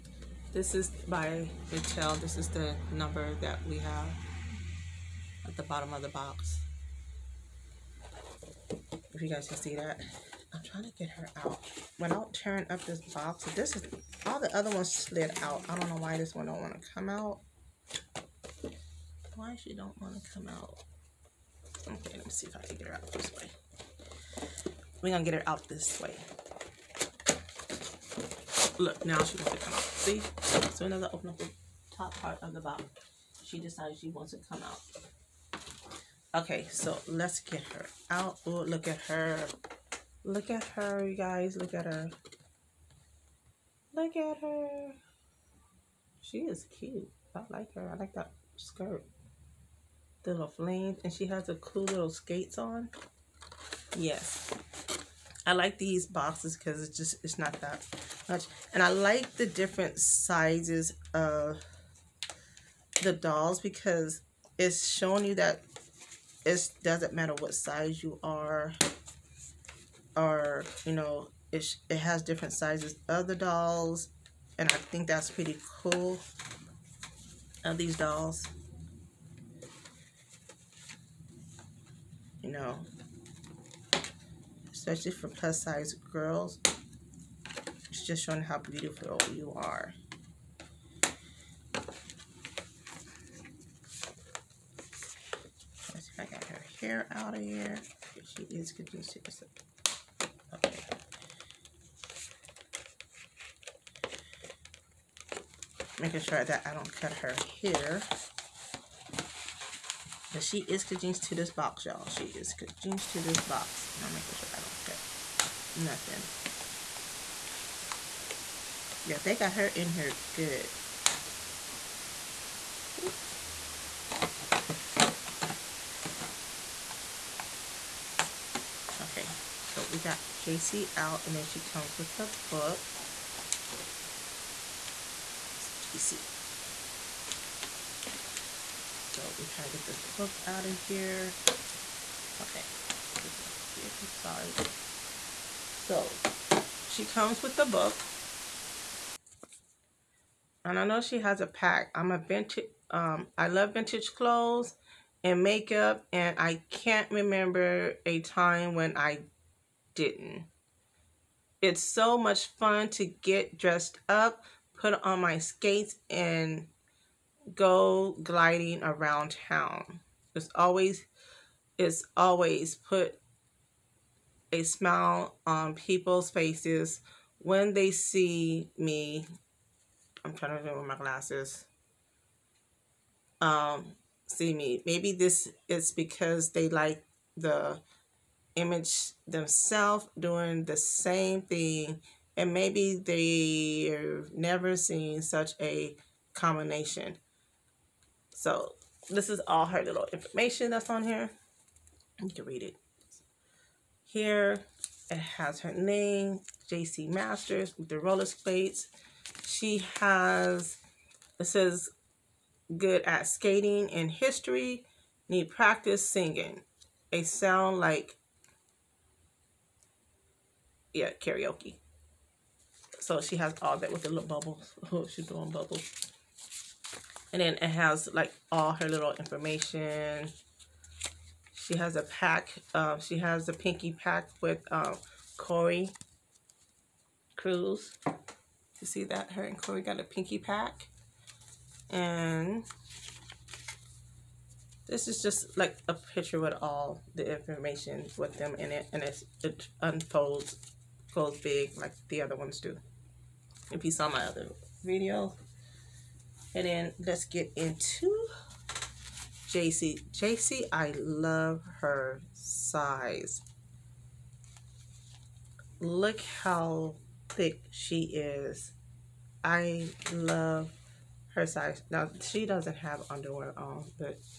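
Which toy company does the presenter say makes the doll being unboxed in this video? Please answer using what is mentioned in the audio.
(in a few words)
Mattel.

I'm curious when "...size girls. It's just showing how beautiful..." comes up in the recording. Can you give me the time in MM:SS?
01:25.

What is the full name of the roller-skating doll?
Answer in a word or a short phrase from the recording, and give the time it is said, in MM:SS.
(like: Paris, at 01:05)
JC Masters, at 03:26.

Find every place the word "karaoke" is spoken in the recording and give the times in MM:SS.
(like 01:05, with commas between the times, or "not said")
03:41.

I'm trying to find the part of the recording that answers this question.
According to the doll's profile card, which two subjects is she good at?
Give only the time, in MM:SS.
03:33.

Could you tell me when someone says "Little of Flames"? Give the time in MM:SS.
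00:50.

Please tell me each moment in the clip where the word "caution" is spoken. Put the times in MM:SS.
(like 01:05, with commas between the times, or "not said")
not said.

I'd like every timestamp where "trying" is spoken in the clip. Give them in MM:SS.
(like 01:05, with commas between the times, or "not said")
00:10, 02:19, 03:00.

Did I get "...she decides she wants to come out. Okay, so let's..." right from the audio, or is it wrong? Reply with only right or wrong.
right.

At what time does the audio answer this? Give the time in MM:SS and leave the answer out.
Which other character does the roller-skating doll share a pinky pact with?
03:55.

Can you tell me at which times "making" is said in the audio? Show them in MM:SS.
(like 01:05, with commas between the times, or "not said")
01:46, 01:54.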